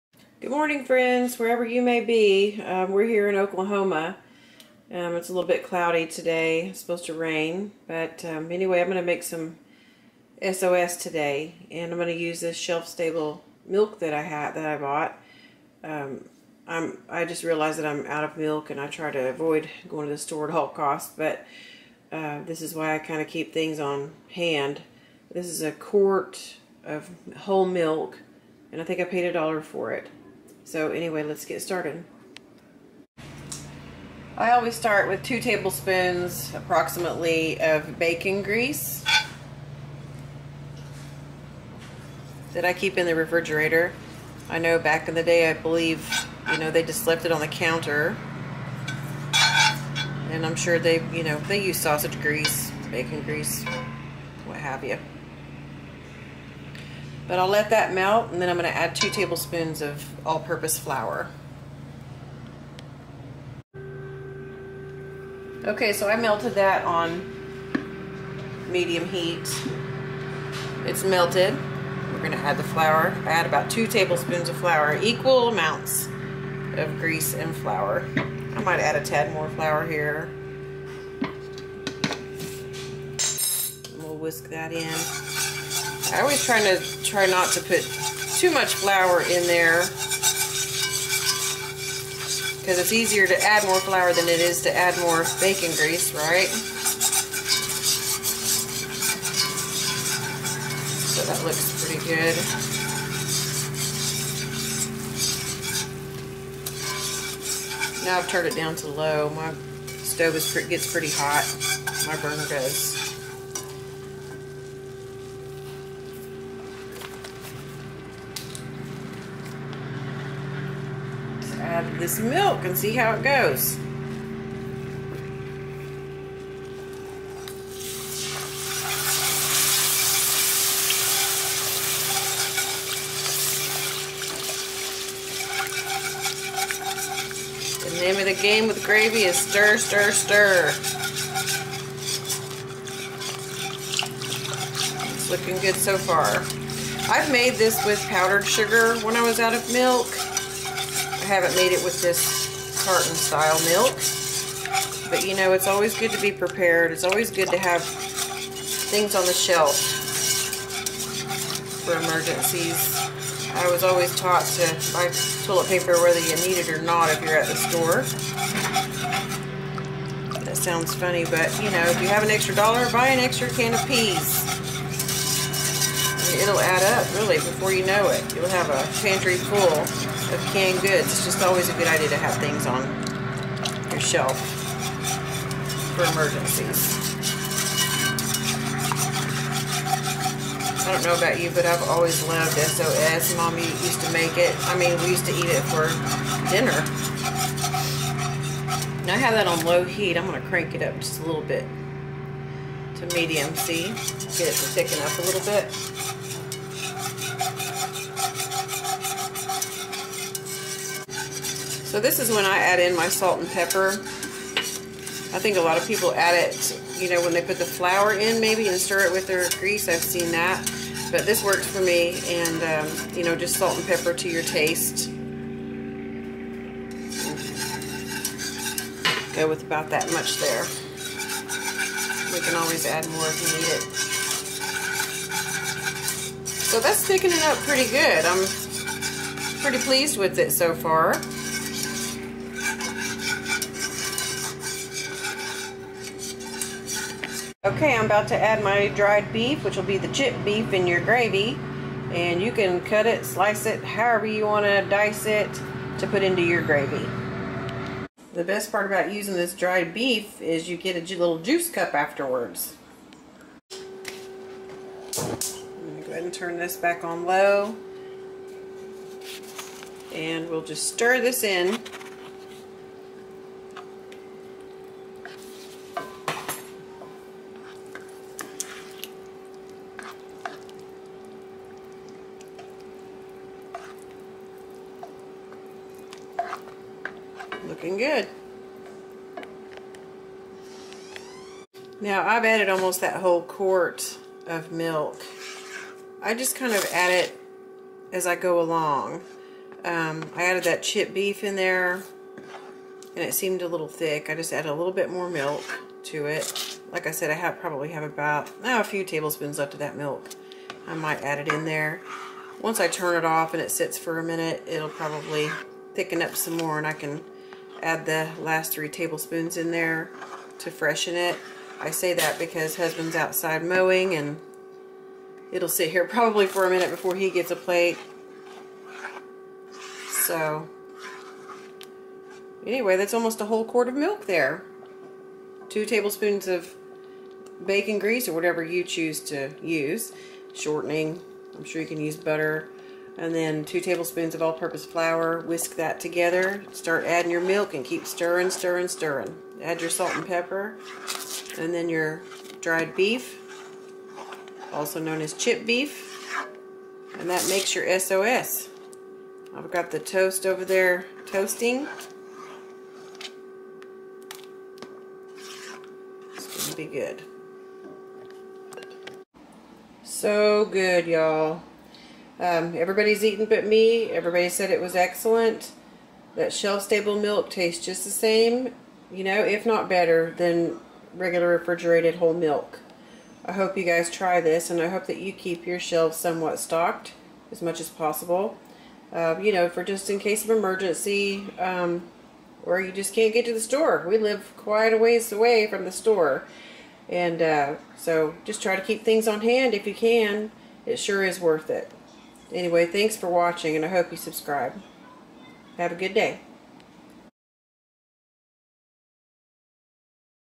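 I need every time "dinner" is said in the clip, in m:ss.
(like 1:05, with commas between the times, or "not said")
3:16.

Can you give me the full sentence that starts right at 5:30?
So anyway, that's almost a whole quart of milk there.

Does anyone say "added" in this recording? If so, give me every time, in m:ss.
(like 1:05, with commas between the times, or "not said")
4:52, 5:00.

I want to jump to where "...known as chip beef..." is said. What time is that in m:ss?
5:54.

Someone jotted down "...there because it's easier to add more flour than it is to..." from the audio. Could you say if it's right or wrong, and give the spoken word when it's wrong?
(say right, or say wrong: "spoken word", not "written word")
right.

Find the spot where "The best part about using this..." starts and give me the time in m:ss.
4:18.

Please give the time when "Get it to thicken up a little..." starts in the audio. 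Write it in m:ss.
3:23.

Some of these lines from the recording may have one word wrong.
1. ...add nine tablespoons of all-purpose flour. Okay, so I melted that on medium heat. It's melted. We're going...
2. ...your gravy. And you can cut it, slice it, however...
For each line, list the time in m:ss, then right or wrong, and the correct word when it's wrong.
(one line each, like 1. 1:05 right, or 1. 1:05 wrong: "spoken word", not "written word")
1. 0:58 wrong: "two", not "nine"
2. 4:10 right.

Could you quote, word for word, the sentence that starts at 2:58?
You'll have a pantry full of canned goods.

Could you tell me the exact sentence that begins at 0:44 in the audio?
I know back in the day, I believe, you know, they just left it on the counter.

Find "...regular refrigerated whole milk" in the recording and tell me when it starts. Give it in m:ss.
6:21.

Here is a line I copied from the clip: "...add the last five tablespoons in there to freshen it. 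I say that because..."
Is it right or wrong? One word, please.
wrong.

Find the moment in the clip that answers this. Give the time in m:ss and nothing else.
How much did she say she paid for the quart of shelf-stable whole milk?
0:29.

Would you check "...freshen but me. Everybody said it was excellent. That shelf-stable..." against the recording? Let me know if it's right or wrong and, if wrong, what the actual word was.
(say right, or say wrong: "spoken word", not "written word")
wrong: "eaten", not "freshen".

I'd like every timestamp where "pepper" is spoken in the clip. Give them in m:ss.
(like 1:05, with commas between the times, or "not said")
3:33, 3:43, 5:50.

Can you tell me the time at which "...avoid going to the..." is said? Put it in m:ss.
0:19.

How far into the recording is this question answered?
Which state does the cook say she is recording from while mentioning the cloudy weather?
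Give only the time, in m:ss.
0:03.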